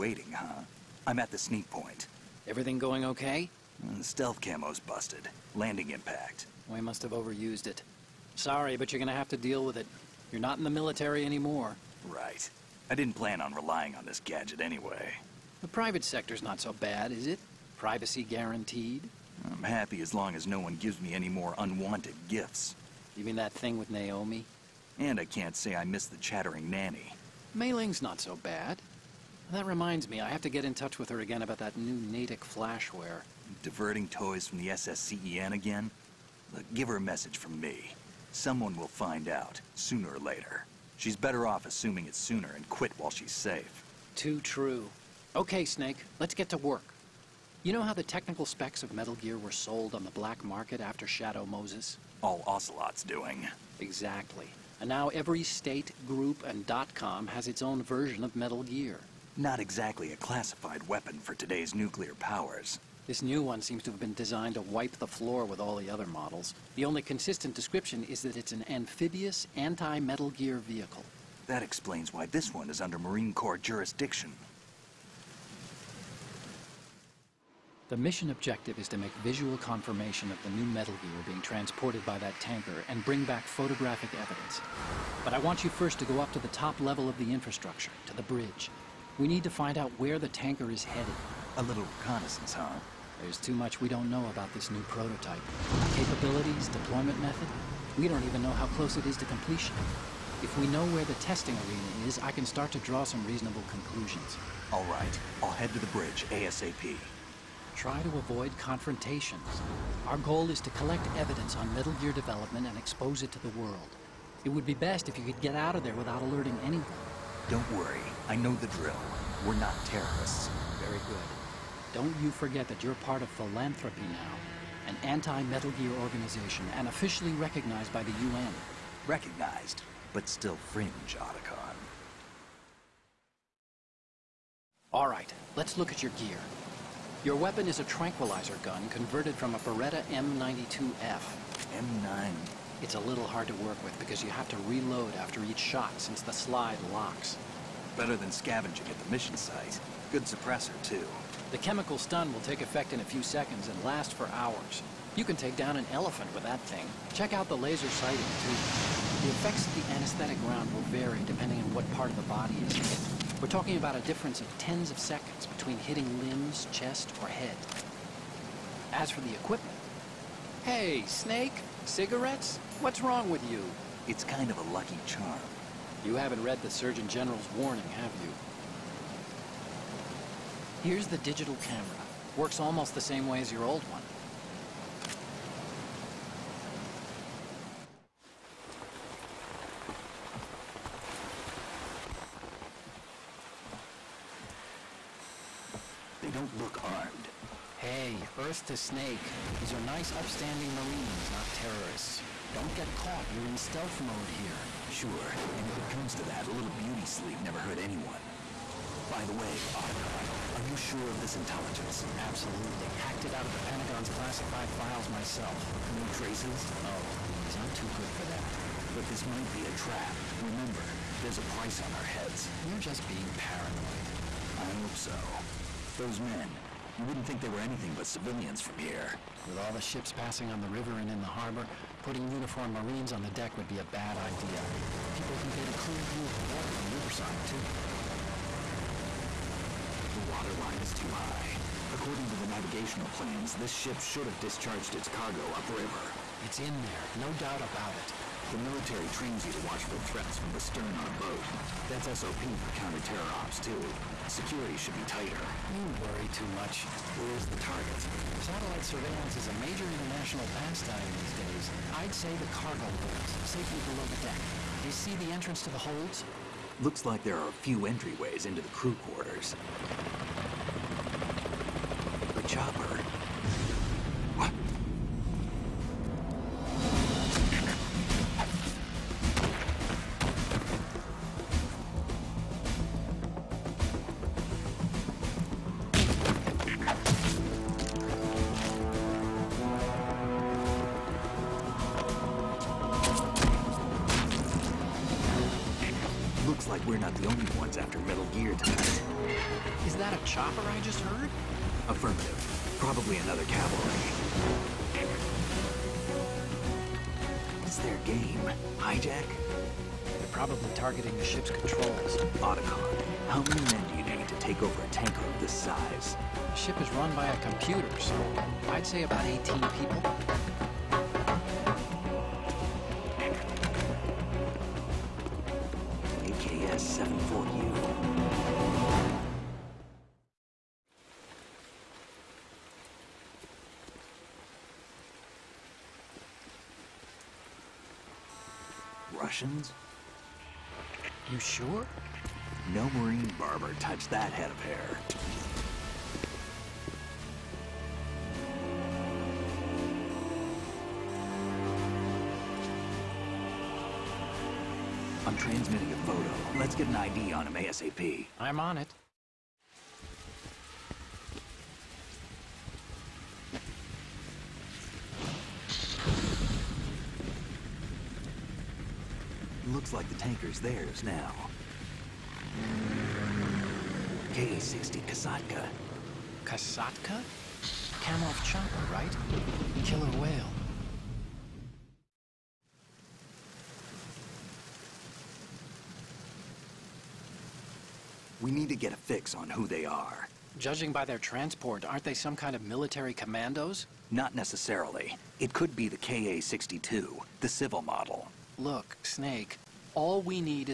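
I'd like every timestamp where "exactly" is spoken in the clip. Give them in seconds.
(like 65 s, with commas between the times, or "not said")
53 s, 59 s.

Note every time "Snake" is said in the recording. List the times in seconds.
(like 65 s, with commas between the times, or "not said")
45 s, 171 s, 198 s, 399 s.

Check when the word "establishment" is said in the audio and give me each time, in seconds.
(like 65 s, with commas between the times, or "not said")
not said.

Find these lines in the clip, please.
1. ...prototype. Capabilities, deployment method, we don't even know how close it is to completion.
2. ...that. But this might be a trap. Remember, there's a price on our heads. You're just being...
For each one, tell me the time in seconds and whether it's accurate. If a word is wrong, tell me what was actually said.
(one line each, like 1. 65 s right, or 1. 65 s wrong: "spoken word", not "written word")
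1. 94 s right
2. 218 s right.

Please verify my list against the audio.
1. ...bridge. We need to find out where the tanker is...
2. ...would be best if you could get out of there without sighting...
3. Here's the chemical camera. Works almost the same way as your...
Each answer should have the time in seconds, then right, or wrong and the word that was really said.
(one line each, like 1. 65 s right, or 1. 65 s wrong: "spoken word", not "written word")
1. 88 s right
2. 114 s wrong: "alerting", not "sighting"
3. 180 s wrong: "digital", not "chemical".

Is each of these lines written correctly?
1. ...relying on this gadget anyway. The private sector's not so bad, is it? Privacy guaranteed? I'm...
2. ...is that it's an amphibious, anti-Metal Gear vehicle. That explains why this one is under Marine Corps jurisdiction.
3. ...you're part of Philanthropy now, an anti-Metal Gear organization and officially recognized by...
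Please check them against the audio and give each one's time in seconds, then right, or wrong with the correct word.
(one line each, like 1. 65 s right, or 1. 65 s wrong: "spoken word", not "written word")
1. 13 s right
2. 68 s right
3. 122 s right.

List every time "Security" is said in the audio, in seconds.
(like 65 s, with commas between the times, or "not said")
254 s.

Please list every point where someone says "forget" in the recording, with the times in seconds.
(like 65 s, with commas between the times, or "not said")
122 s.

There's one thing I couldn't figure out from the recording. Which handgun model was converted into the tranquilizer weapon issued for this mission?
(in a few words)
Beretta M92F.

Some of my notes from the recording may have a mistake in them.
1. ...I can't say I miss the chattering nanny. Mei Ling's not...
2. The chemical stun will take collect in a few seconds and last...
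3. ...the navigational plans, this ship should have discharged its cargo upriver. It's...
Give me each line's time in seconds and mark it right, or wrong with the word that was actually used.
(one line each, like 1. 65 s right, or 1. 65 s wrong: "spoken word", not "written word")
1. 25 s right
2. 151 s wrong: "effect", not "collect"
3. 242 s right.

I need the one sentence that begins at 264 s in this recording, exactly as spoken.
Do you see the entrance to the holds?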